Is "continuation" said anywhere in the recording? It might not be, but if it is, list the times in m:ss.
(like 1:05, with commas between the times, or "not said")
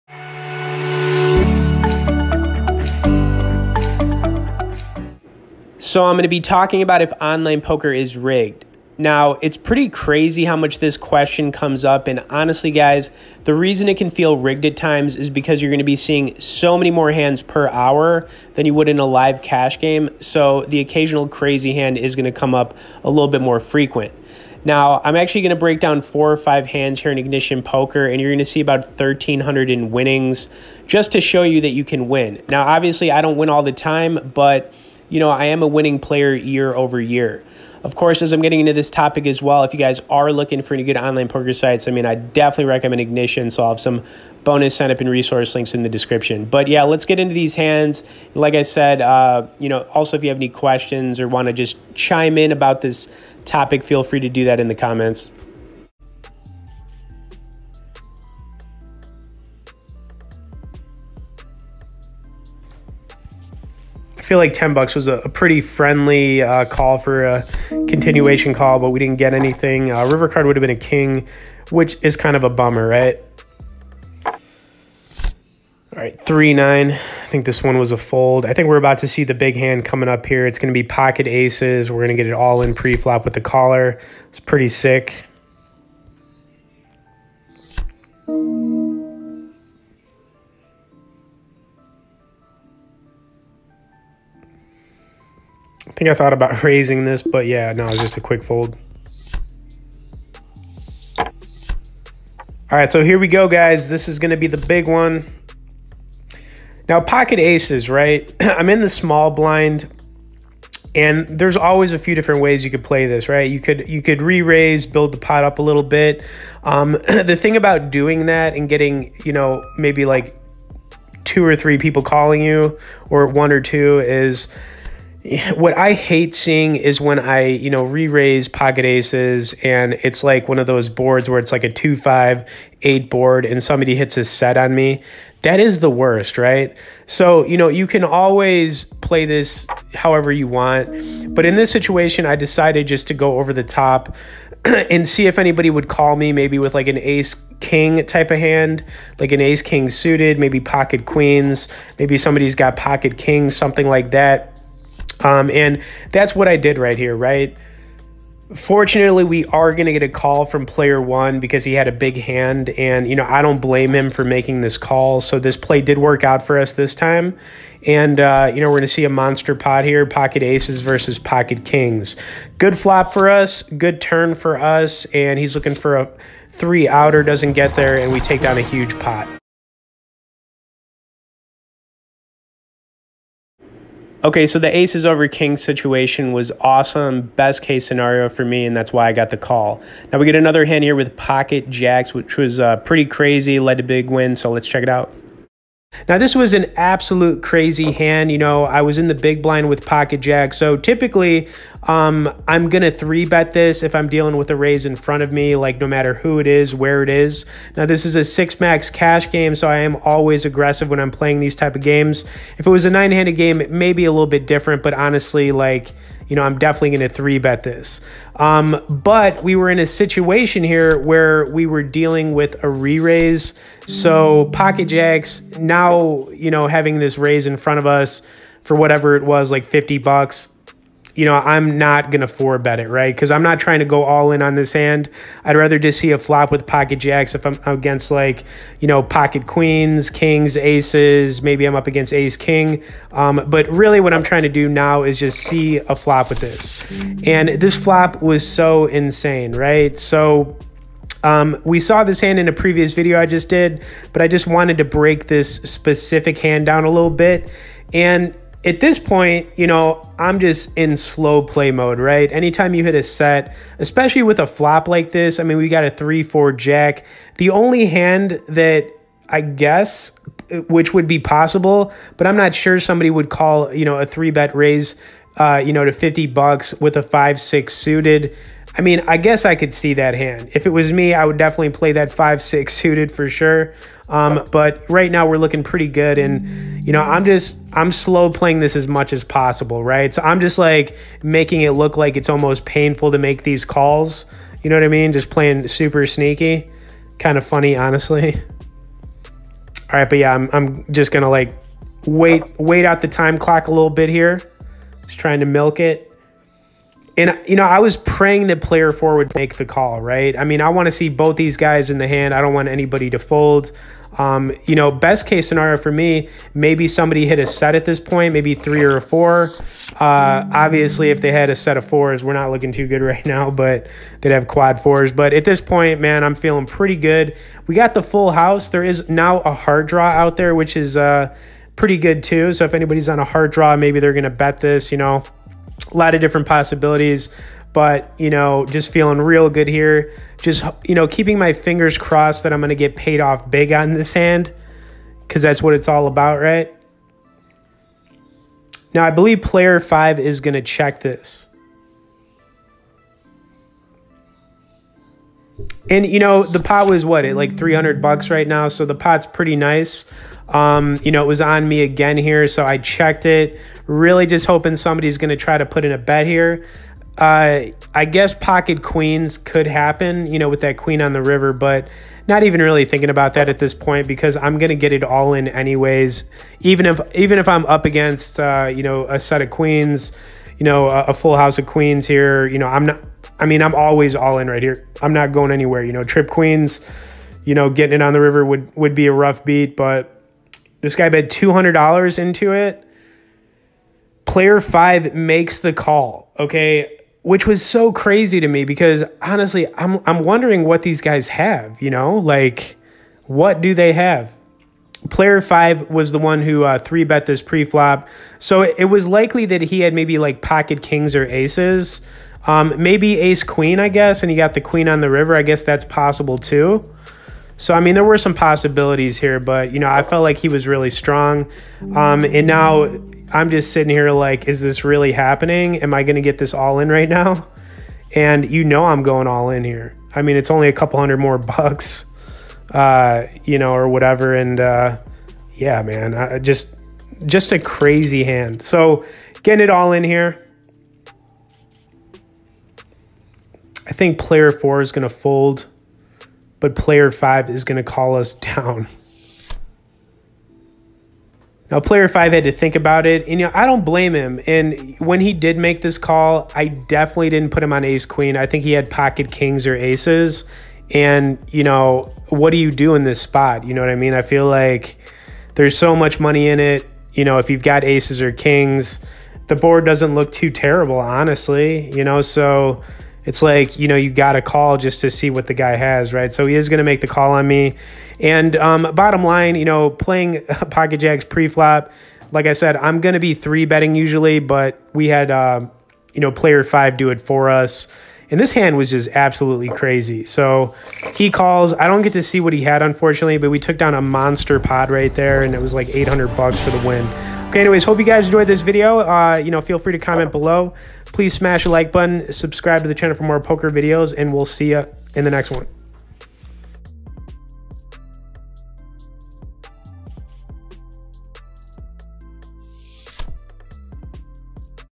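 1:07.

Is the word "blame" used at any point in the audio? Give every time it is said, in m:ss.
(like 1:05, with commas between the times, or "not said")
2:43, 7:33.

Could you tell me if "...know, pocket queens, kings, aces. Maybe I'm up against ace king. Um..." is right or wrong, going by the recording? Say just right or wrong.
right.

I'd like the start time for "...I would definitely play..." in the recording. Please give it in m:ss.
4:41.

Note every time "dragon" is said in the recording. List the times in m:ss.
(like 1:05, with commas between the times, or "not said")
not said.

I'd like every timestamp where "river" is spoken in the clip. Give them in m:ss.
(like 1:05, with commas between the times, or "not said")
1:10, 6:11, 6:28, 6:55.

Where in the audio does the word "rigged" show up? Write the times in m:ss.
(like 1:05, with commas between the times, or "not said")
0:08, 0:14.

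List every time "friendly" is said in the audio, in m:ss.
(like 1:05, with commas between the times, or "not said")
1:05.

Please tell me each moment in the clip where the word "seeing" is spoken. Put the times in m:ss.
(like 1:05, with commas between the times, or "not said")
0:15, 2:06.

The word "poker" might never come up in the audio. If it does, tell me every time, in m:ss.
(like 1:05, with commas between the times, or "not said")
0:07, 0:27, 0:41, 8:23.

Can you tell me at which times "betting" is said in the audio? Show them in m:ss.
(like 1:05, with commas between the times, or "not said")
8:03.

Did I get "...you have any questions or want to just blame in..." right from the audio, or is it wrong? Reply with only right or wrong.
wrong.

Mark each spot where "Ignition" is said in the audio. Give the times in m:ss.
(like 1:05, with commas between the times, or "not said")
0:27, 0:43.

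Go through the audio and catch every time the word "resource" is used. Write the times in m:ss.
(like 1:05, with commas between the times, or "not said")
0:45.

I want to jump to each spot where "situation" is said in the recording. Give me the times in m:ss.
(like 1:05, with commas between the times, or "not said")
2:21, 3:05, 3:39.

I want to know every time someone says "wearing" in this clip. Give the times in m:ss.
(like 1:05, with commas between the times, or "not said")
not said.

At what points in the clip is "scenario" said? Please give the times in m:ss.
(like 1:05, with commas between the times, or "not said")
3:07, 5:15.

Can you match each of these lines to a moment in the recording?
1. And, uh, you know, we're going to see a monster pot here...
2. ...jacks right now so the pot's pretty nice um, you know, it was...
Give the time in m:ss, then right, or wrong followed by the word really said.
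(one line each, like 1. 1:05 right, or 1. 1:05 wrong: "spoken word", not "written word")
1. 2:47 right
2. 5:58 wrong: "bucks", not "jacks".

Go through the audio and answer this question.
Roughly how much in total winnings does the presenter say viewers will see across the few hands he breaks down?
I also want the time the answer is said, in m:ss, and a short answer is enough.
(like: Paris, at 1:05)
1,300, at 0:28.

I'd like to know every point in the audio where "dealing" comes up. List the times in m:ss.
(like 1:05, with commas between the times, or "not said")
3:24, 3:41.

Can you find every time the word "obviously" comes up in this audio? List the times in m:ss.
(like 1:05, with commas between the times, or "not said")
0:32, 5:20.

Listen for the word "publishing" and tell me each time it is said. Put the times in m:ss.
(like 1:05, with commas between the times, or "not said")
not said.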